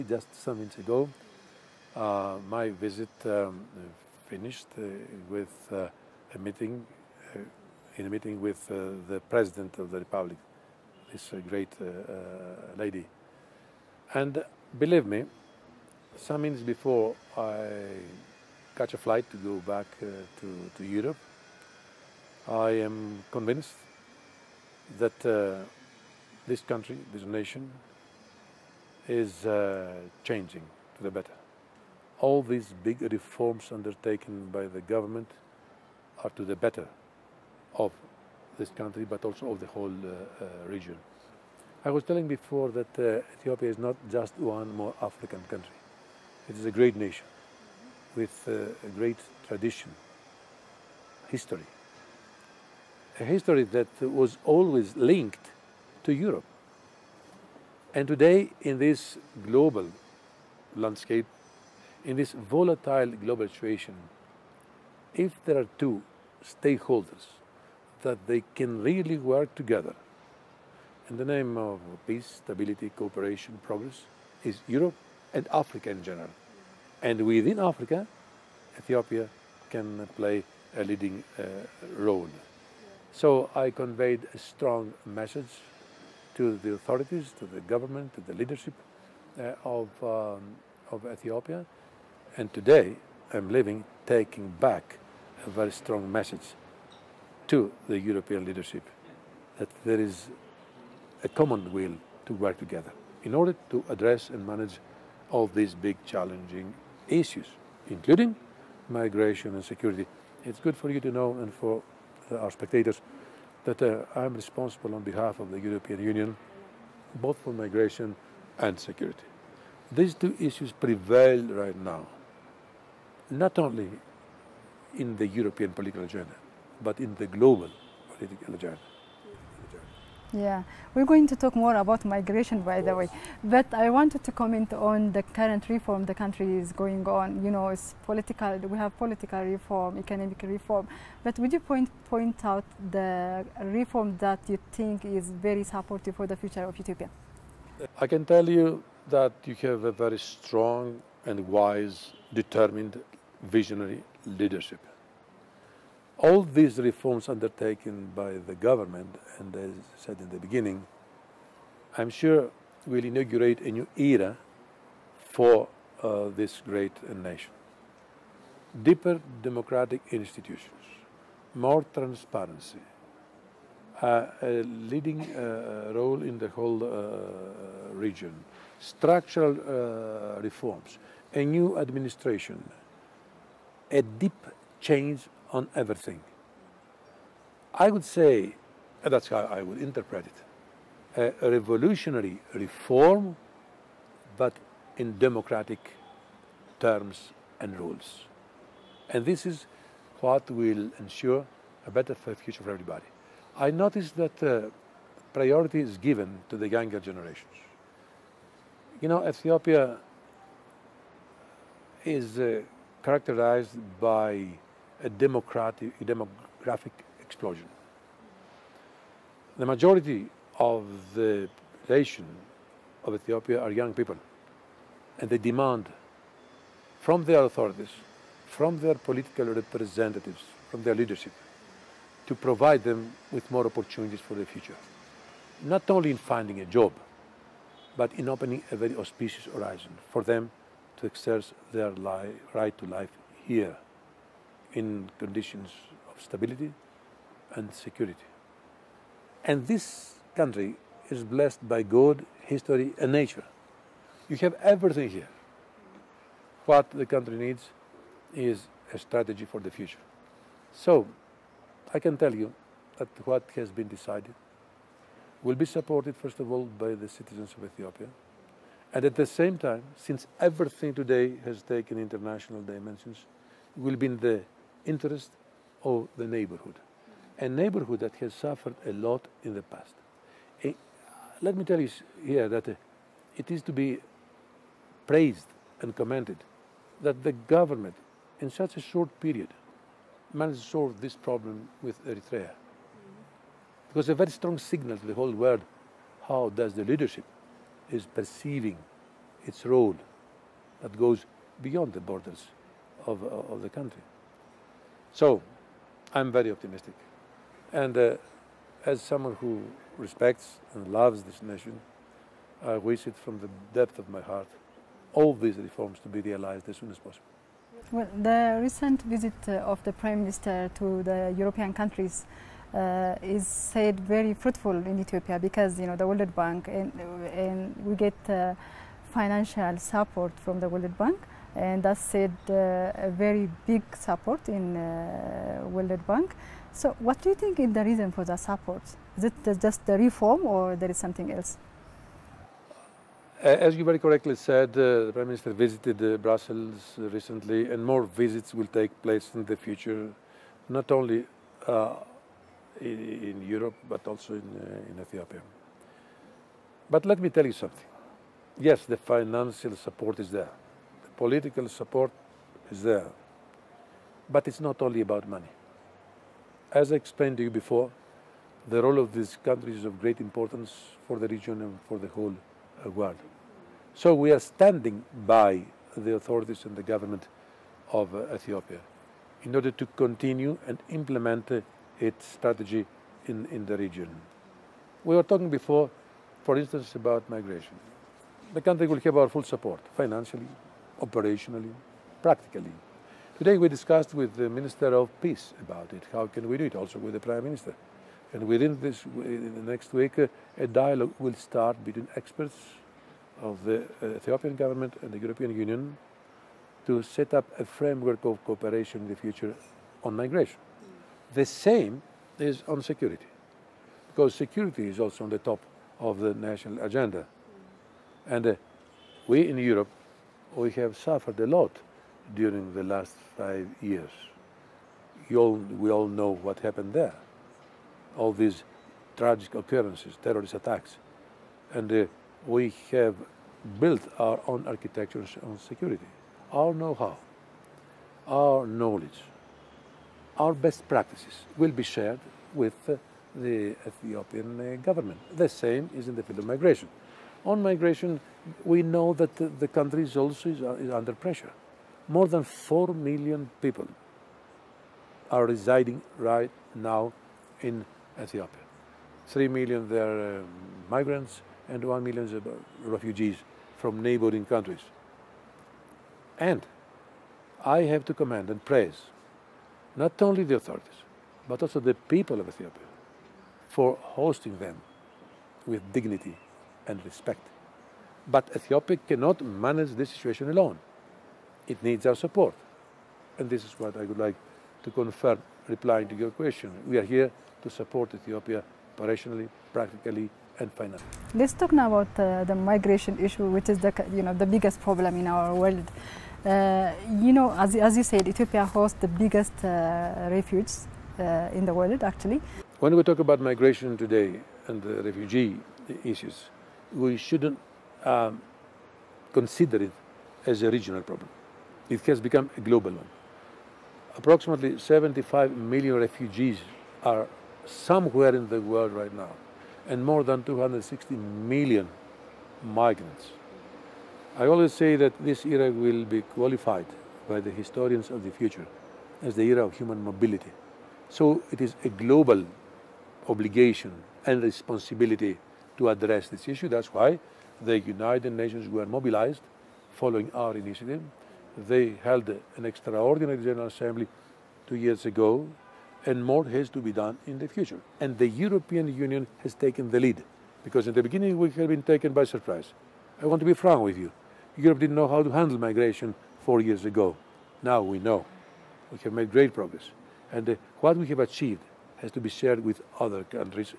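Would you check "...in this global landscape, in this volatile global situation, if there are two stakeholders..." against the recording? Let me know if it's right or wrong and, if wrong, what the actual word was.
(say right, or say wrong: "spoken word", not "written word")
right.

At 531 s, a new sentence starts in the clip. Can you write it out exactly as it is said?
So it is a global obligation and responsibility to address this issue.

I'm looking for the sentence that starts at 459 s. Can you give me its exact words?
3 they're uh, migrants and 1 million are uh, refugees from neighboring countries.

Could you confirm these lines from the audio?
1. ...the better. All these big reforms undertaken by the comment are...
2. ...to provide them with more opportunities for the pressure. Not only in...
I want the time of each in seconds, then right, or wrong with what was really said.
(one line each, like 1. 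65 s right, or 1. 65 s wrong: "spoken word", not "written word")
1. 31 s wrong: "government", not "comment"
2. 232 s wrong: "future", not "pressure".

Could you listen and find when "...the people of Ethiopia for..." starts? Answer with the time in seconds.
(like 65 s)
471 s.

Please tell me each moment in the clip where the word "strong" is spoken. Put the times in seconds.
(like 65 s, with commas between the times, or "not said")
84 s, 95 s, 150 s, 294 s.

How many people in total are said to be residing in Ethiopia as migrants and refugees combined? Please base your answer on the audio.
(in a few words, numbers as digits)
More than 4 million.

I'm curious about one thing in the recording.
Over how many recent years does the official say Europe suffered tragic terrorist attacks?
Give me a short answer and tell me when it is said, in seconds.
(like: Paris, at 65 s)
5 years, at 423 s.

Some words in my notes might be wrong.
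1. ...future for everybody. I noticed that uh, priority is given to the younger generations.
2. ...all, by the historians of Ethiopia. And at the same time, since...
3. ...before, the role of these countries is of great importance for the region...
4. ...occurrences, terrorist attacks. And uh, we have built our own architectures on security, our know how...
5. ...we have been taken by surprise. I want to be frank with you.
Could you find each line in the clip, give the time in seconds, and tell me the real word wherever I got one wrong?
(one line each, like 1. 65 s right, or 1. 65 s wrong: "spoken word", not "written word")
1. 202 s right
2. 266 s wrong: "citizens", not "historians"
3. 367 s right
4. 429 s right
5. 551 s right.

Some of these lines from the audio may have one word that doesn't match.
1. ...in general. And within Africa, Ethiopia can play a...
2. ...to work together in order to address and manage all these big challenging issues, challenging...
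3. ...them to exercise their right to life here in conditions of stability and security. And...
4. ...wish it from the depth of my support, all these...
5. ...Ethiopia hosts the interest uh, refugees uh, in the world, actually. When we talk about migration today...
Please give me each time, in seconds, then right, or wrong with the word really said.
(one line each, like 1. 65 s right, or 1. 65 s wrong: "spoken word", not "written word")
1. 75 s right
2. 102 s wrong: "including", not "challenging"
3. 240 s right
4. 312 s wrong: "heart", not "support"
5. 498 s wrong: "biggest", not "interest".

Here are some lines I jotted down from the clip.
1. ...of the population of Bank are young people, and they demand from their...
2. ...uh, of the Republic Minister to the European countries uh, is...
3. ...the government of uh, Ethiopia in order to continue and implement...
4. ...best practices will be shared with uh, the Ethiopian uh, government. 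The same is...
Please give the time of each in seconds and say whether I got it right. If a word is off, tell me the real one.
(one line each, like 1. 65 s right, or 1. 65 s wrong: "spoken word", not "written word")
1. 220 s wrong: "Ethiopia", not "Bank"
2. 319 s wrong: "Prime", not "Republic"
3. 376 s right
4. 440 s right.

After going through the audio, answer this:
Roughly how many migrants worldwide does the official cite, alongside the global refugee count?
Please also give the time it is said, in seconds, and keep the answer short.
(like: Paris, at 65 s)
260 million, at 520 s.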